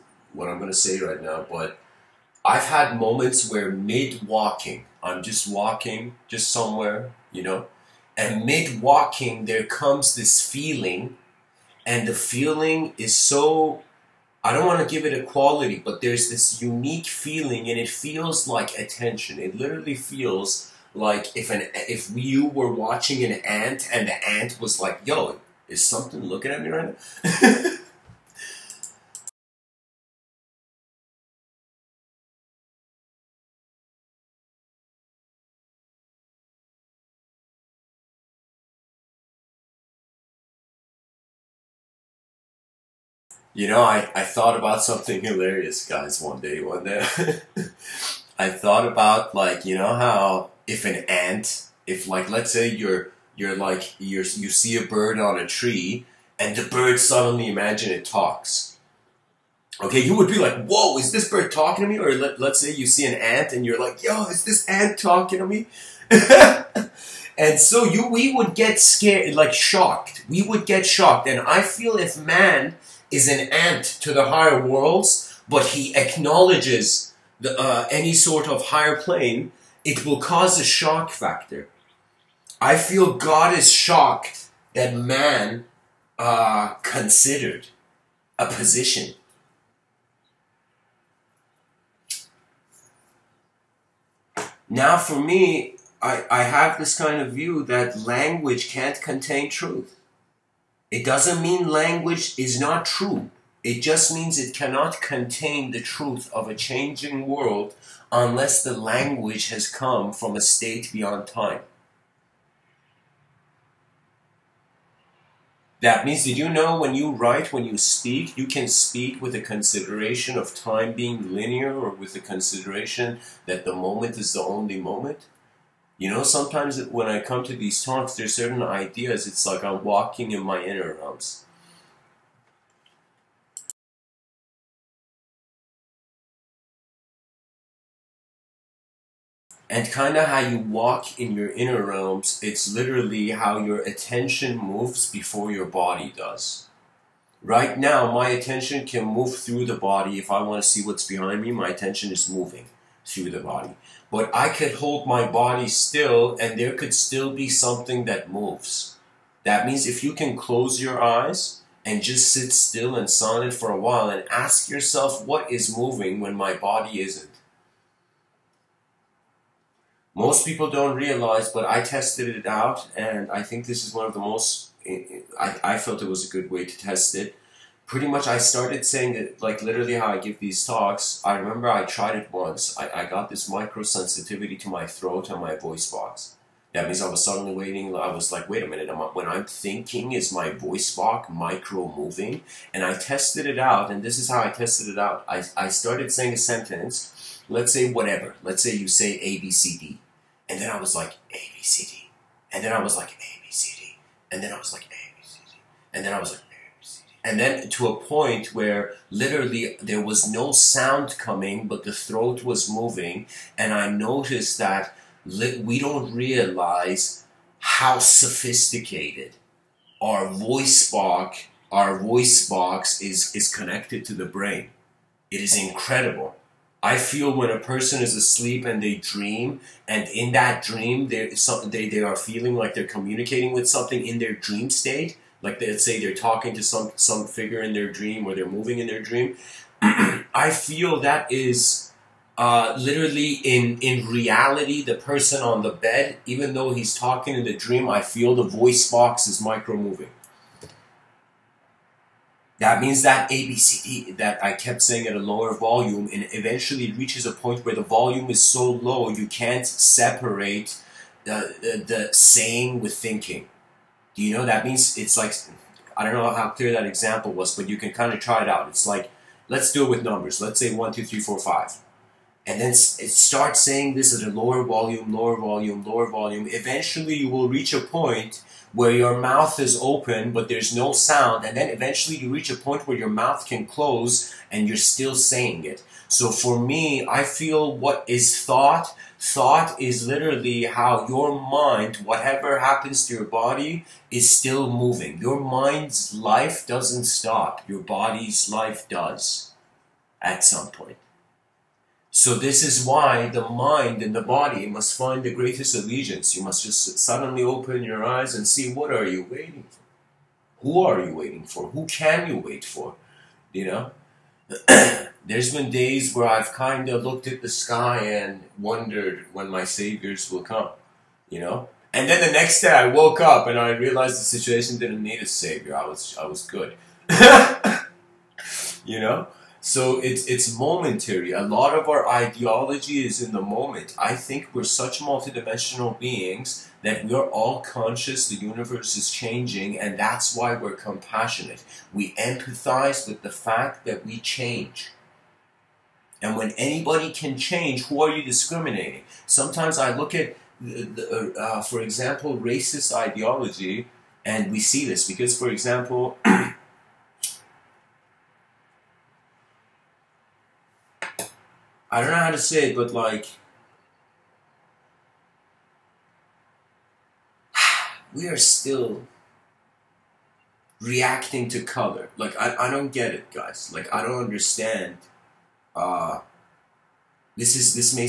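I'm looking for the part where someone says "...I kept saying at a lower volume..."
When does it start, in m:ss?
4:14.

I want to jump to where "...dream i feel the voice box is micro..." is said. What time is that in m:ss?
4:07.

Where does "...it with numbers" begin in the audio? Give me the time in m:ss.
4:29.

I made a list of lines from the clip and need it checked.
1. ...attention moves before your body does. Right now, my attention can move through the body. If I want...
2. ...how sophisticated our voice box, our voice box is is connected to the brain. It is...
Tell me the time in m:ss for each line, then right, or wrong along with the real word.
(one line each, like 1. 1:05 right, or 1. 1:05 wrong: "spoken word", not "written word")
1. 2:23 right
2. 3:37 right.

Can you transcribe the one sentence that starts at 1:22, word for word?
I feel God is shocked that man uh, considered a position.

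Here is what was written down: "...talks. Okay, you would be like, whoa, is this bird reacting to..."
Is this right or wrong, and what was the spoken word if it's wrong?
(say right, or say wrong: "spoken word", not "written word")
wrong: "talking", not "reacting".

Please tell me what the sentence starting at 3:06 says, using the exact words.
That means I was suddenly waiting.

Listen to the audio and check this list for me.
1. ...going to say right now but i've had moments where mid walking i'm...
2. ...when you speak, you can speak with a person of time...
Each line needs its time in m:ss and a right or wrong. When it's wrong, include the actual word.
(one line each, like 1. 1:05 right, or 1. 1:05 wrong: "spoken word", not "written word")
1. 0:00 right
2. 1:57 wrong: "consideration", not "person".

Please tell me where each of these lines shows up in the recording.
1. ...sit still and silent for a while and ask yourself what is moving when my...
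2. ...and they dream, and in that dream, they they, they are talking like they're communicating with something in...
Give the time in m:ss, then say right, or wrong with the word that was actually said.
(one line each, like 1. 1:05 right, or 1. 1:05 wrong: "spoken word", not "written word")
1. 2:42 right
2. 3:48 wrong: "feeling", not "talking".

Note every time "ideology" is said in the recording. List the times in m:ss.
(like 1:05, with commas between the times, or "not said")
5:32, 5:52.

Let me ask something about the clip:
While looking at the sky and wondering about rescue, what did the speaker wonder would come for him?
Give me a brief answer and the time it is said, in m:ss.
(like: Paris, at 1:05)
saviors, at 5:19.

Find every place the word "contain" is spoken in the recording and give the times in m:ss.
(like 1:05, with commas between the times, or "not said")
1:39, 1:45.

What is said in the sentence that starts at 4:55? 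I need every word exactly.
Your mind's life doesn't stop, your body's life does at some point.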